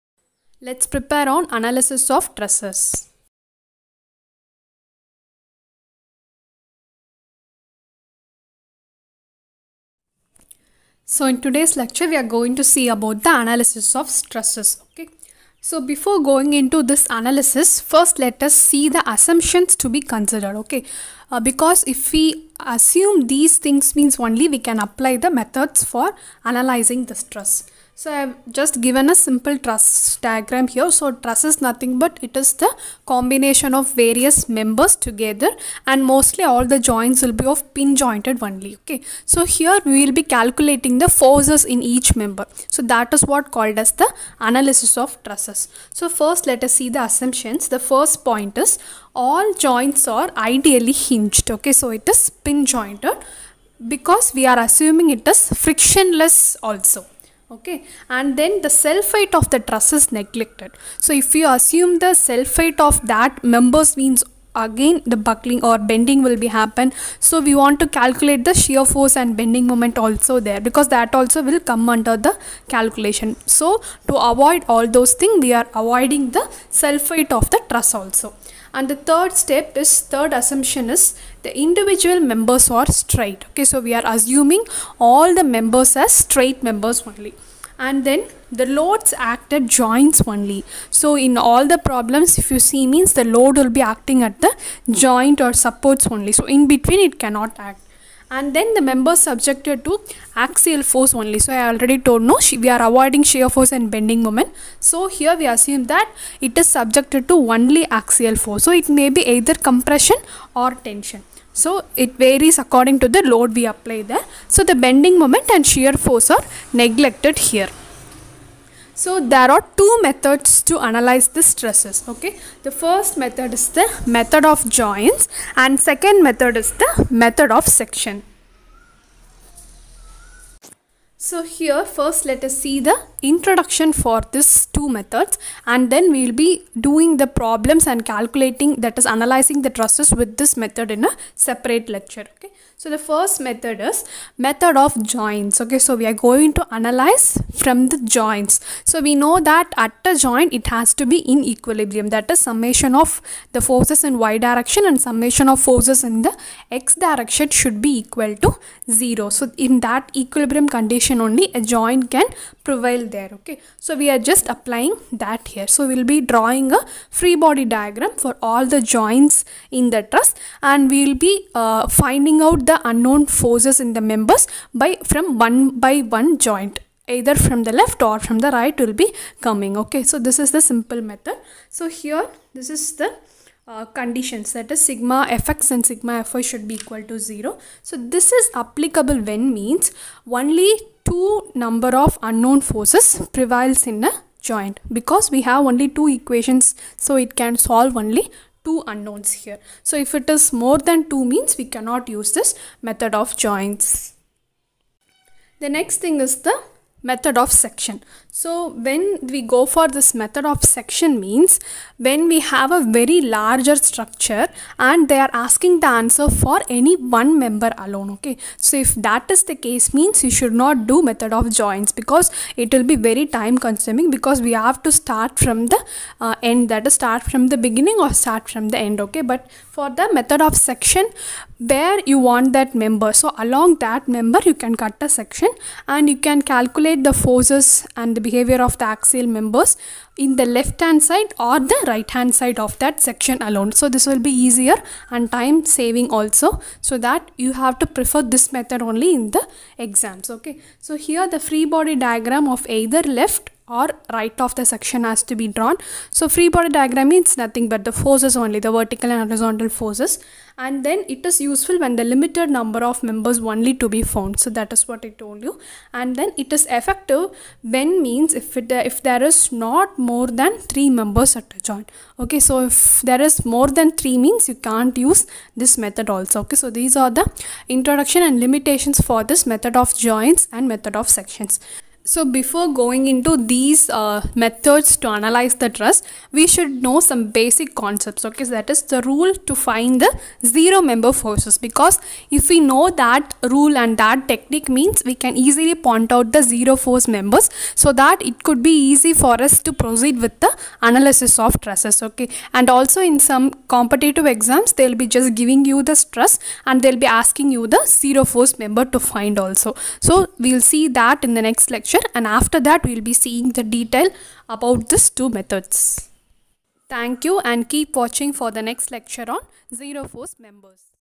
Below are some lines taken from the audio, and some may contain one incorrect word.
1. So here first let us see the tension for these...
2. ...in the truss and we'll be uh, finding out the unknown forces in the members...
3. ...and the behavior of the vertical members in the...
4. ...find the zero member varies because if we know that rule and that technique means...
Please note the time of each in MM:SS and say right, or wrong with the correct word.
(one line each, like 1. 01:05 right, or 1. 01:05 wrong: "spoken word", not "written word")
1. 02:11 wrong: "introduction", not "tension"
2. 02:49 right
3. 03:57 wrong: "axial", not "vertical"
4. 04:49 wrong: "forces", not "varies".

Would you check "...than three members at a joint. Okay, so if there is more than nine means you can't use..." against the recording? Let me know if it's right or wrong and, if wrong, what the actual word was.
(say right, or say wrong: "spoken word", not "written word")
wrong: "three", not "nine".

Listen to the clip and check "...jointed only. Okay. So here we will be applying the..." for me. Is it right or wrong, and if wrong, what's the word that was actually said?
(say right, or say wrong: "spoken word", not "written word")
wrong: "calculating", not "applying".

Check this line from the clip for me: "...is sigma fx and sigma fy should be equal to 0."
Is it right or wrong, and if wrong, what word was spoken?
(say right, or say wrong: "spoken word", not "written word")
right.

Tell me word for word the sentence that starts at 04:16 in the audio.
So free body diagram means nothing but the forces only, the vertical and horizontal forces.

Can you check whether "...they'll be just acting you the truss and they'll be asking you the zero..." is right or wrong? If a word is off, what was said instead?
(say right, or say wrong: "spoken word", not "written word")
wrong: "giving", not "acting".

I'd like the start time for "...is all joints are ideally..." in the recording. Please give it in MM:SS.
00:48.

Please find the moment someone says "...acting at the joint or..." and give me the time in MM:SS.
01:33.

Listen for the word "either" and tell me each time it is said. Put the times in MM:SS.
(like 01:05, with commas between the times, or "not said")
01:49, 02:57, 04:12.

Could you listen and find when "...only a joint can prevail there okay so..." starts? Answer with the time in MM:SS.
02:41.